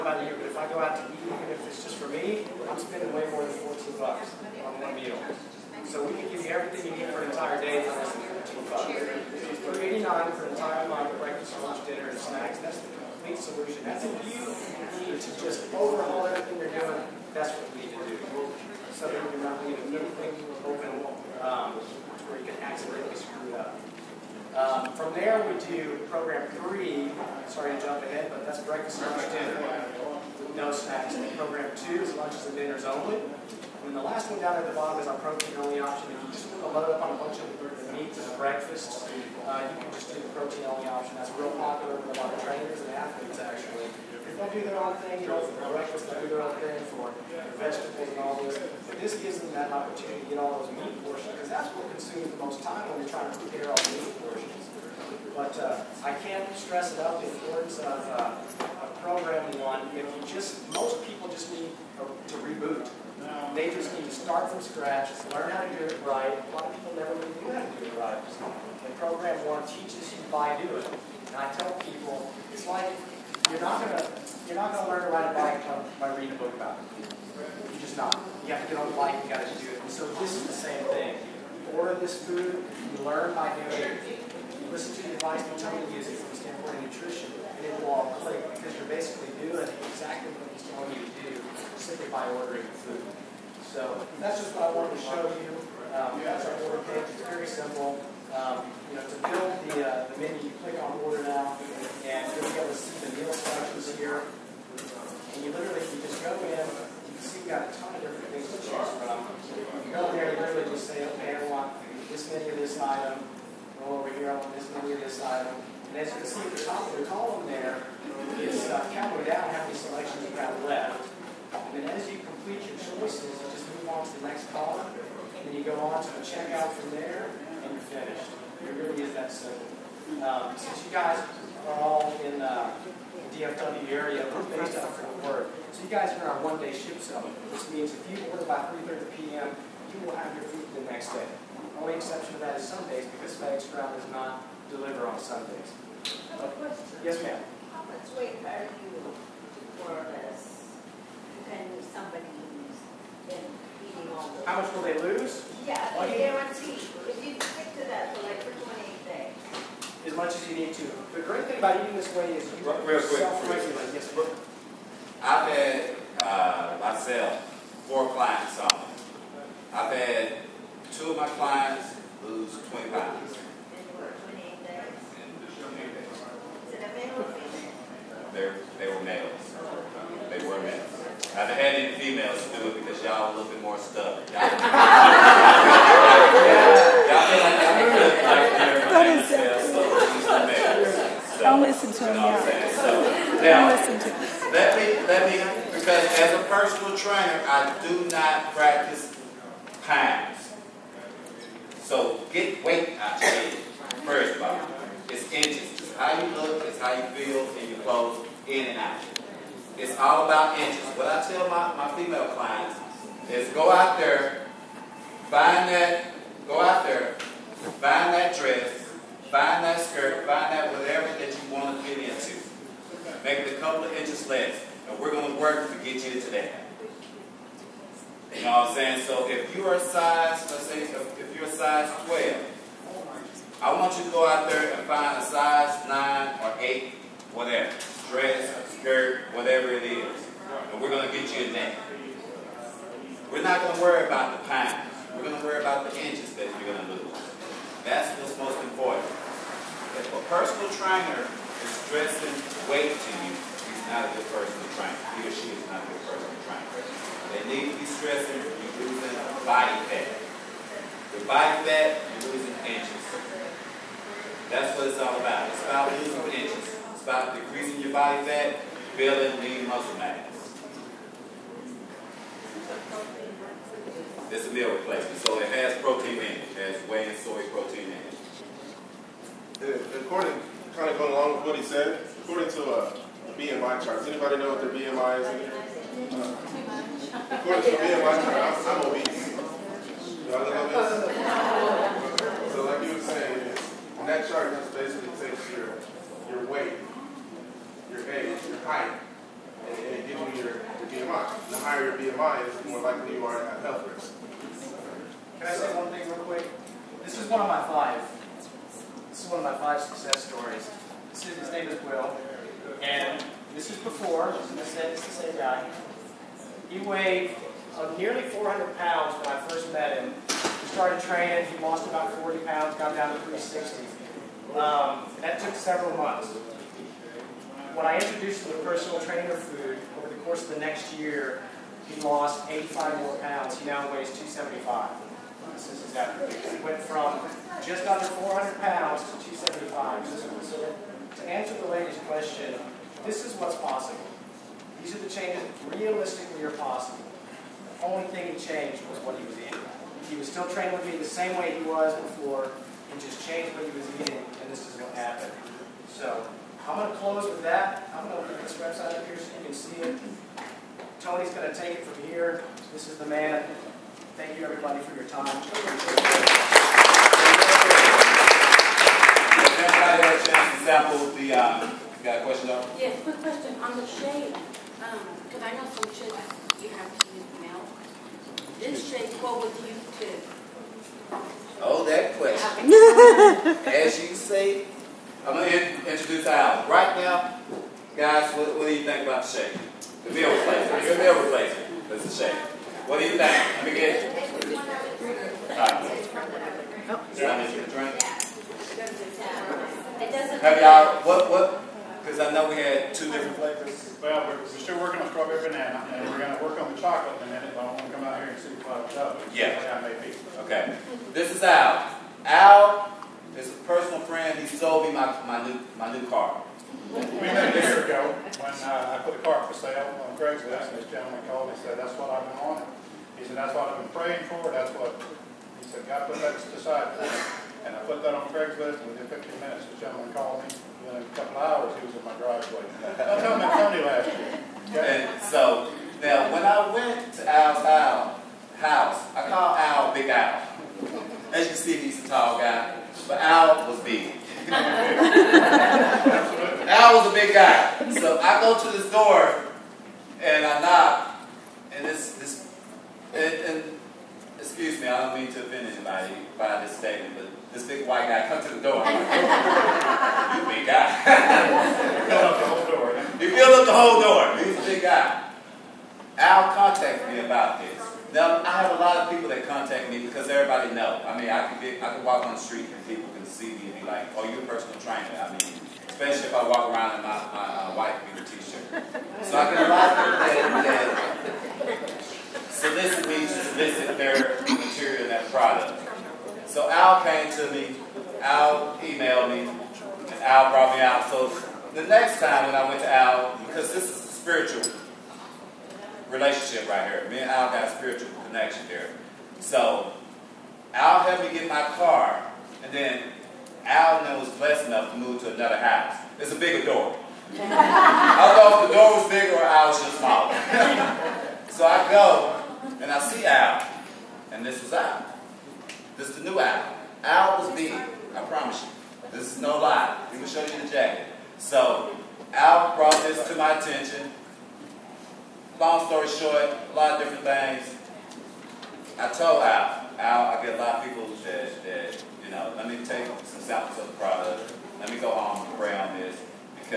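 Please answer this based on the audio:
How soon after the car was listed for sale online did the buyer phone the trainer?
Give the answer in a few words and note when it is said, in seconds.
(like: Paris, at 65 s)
15 minutes, at 429 s.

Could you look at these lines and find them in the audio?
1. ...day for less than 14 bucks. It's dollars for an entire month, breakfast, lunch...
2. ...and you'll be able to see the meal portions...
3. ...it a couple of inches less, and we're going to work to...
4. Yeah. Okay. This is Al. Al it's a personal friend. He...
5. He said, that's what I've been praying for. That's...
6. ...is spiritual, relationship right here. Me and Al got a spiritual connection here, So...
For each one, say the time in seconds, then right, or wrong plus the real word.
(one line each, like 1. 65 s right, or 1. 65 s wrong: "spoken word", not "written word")
1. 7 s right
2. 102 s wrong: "selections", not "portions"
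3. 223 s right
4. 409 s right
5. 423 s right
6. 493 s right.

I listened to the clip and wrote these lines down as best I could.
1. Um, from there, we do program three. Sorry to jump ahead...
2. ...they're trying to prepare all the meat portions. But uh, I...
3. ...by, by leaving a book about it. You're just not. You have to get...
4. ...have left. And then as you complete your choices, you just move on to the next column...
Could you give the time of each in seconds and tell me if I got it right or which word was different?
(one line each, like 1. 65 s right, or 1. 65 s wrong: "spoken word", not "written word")
1. 24 s right
2. 53 s right
3. 75 s wrong: "reading", not "leaving"
4. 120 s right.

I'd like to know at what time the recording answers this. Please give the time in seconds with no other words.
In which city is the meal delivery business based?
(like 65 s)
134 s.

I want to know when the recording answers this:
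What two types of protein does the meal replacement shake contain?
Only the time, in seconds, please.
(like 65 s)
276 s.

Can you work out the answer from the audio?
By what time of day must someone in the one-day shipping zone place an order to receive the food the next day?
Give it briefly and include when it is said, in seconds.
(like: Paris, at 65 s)
3:30 p.m., at 138 s.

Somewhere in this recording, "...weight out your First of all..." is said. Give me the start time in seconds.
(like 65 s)
202 s.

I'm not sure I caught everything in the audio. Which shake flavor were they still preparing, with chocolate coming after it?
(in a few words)
strawberry banana.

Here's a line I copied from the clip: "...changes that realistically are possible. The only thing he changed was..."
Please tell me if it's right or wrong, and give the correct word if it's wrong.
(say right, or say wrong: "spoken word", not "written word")
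right.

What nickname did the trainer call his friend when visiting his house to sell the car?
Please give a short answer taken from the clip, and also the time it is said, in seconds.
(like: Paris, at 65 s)
Big Al, at 439 s.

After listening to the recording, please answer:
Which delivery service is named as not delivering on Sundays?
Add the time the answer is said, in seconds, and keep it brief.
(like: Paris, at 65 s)
FedEx Ground, at 143 s.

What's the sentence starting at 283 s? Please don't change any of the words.
Does anybody know what their BMI is?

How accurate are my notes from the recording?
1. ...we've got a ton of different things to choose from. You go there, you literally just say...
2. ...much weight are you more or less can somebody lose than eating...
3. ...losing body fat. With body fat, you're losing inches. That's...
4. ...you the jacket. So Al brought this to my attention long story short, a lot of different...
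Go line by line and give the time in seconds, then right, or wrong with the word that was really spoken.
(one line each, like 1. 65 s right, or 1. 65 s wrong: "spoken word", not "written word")
1. 107 s right
2. 147 s right
3. 258 s right
4. 520 s right.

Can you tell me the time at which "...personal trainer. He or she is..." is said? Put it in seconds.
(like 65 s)
254 s.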